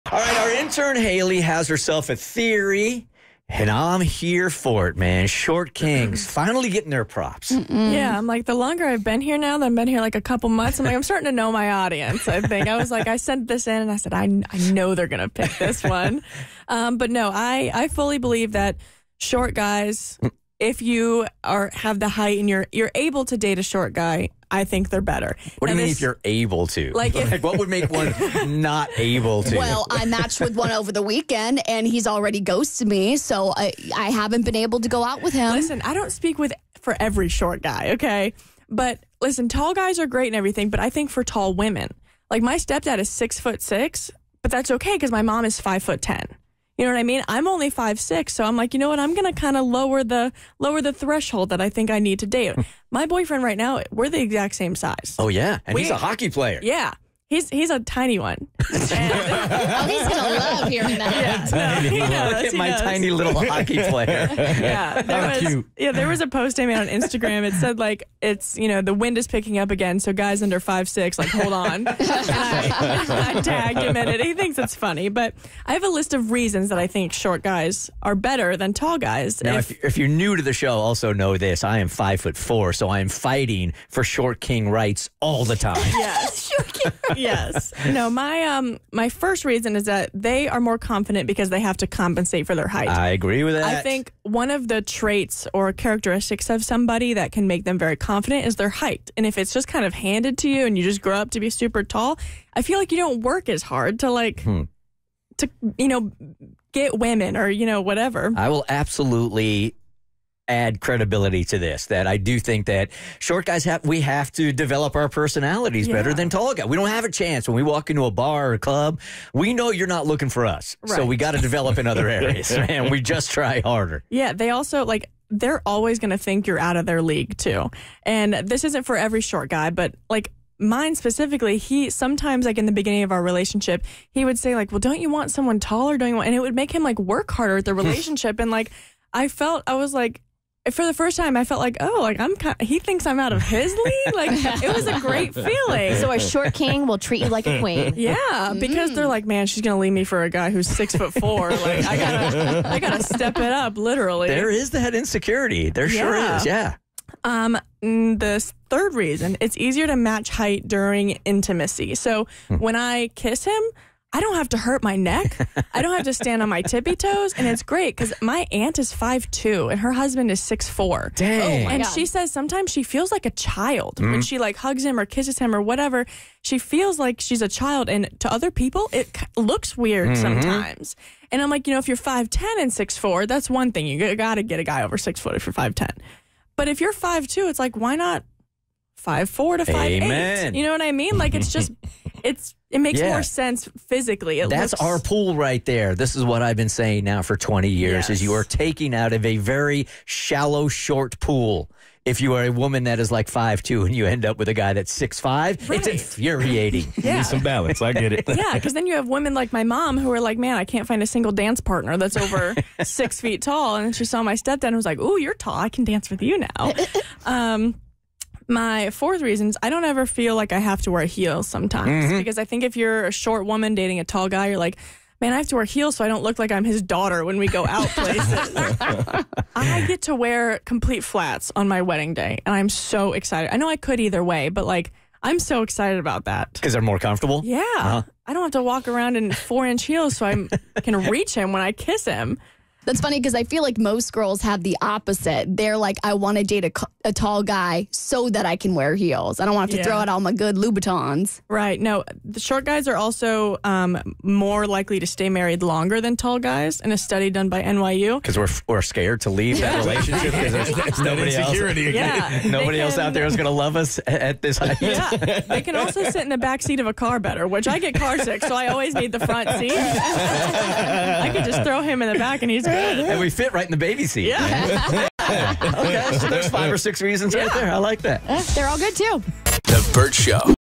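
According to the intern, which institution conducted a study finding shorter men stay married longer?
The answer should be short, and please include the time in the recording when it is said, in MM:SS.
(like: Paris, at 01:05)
NYU, at 04:17.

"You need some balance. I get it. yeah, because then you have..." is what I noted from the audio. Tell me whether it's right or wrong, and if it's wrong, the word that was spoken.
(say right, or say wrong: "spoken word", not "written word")
right.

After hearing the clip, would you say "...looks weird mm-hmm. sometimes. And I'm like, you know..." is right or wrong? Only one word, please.
right.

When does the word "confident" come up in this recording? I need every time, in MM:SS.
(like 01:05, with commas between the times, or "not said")
01:30, 01:37.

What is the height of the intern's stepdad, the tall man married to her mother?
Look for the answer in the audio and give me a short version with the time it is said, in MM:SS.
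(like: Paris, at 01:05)
6 foot 6, at 00:43.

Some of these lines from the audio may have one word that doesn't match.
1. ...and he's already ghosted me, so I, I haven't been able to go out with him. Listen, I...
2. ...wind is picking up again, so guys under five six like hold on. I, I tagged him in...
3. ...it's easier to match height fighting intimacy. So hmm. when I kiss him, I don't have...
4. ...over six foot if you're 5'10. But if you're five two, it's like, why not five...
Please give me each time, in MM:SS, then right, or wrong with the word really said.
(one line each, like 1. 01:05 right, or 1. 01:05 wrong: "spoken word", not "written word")
1. 00:31 right
2. 01:08 right
3. 02:39 wrong: "during", not "fighting"
4. 03:04 right.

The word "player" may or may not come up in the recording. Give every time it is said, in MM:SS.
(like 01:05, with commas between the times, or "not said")
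00:56, 01:03.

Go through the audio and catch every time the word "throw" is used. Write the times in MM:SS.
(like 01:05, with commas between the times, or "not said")
04:09, 04:31.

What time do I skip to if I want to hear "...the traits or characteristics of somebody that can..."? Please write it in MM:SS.
01:34.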